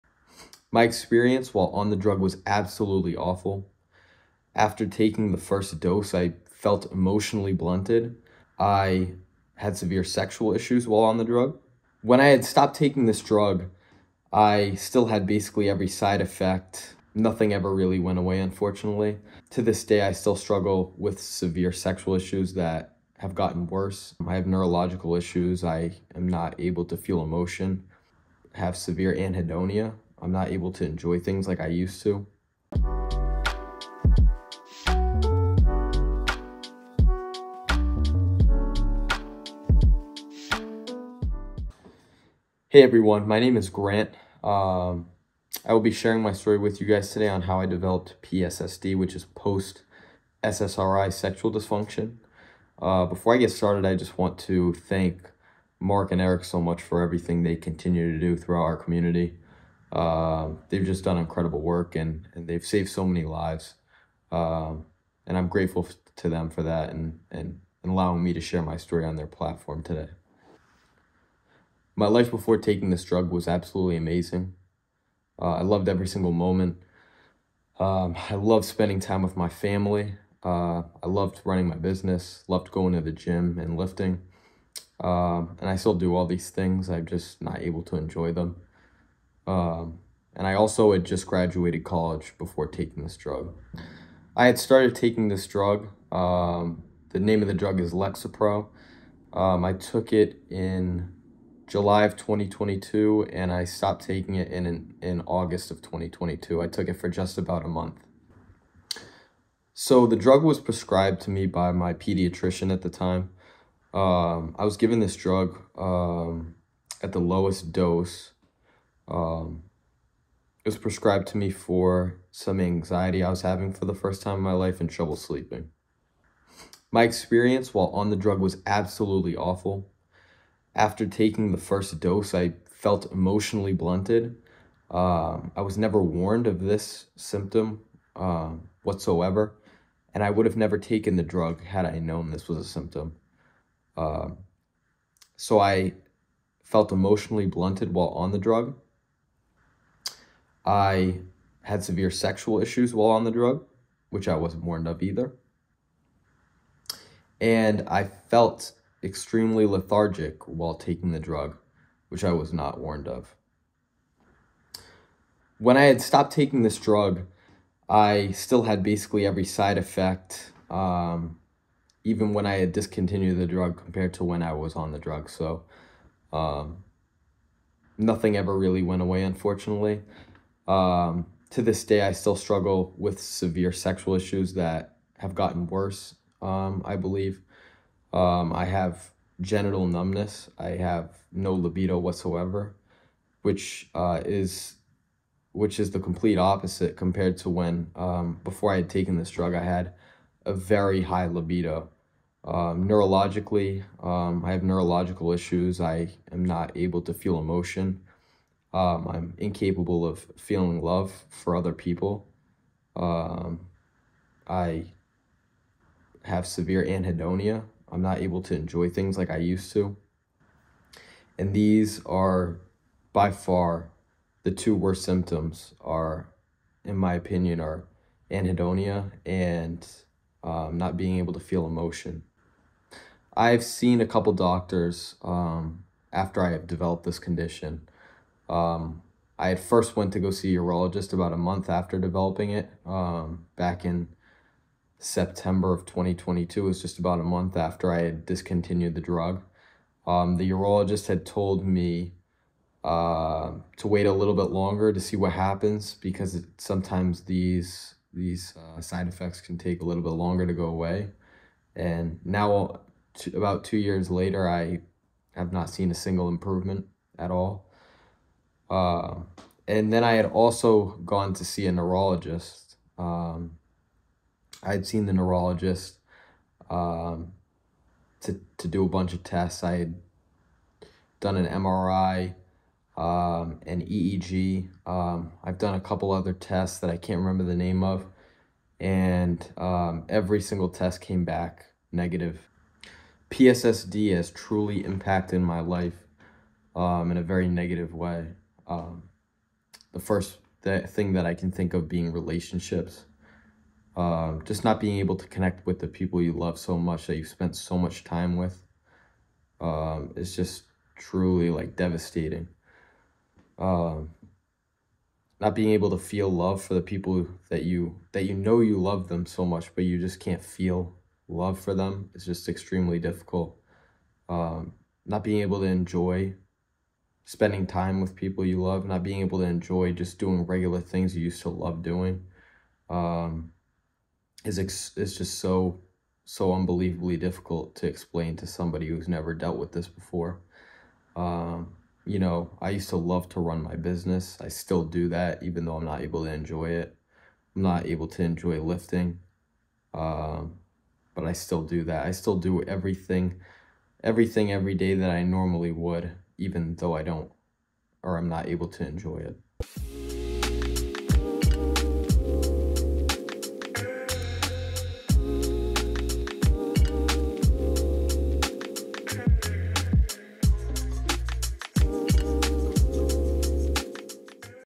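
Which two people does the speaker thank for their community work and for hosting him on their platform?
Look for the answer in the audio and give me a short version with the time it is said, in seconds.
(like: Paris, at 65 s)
Mark and Eric, at 55 s.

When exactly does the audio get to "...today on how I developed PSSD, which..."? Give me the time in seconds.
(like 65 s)
47 s.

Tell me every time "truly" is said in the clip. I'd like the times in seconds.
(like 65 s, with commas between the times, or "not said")
294 s, 310 s.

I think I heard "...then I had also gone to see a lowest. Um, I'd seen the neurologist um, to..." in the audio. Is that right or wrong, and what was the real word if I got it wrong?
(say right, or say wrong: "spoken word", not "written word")
wrong: "neurologist", not "lowest".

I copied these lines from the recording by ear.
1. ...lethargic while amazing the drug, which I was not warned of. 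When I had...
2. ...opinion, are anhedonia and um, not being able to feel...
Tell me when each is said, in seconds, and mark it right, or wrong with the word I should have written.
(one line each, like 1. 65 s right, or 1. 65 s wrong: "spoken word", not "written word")
1. 159 s wrong: "taking", not "amazing"
2. 227 s right.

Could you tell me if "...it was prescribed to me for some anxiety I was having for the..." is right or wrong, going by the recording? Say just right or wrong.
right.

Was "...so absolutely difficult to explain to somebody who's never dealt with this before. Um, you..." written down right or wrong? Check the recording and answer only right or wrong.
wrong.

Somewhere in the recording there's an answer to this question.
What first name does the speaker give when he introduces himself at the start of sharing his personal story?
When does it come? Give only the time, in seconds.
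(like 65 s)
43 s.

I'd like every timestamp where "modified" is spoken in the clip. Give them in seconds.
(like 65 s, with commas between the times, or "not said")
not said.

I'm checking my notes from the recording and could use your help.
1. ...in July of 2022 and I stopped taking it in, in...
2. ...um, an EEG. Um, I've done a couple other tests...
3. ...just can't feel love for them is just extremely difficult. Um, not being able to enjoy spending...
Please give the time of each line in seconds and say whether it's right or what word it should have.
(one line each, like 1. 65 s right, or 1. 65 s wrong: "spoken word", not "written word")
1. 100 s right
2. 282 s right
3. 319 s right.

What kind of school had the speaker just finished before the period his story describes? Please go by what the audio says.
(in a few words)
college.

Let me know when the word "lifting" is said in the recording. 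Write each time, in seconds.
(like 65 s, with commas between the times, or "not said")
83 s, 348 s.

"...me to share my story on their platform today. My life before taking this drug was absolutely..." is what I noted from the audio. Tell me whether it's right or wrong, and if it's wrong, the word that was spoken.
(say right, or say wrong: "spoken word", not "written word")
right.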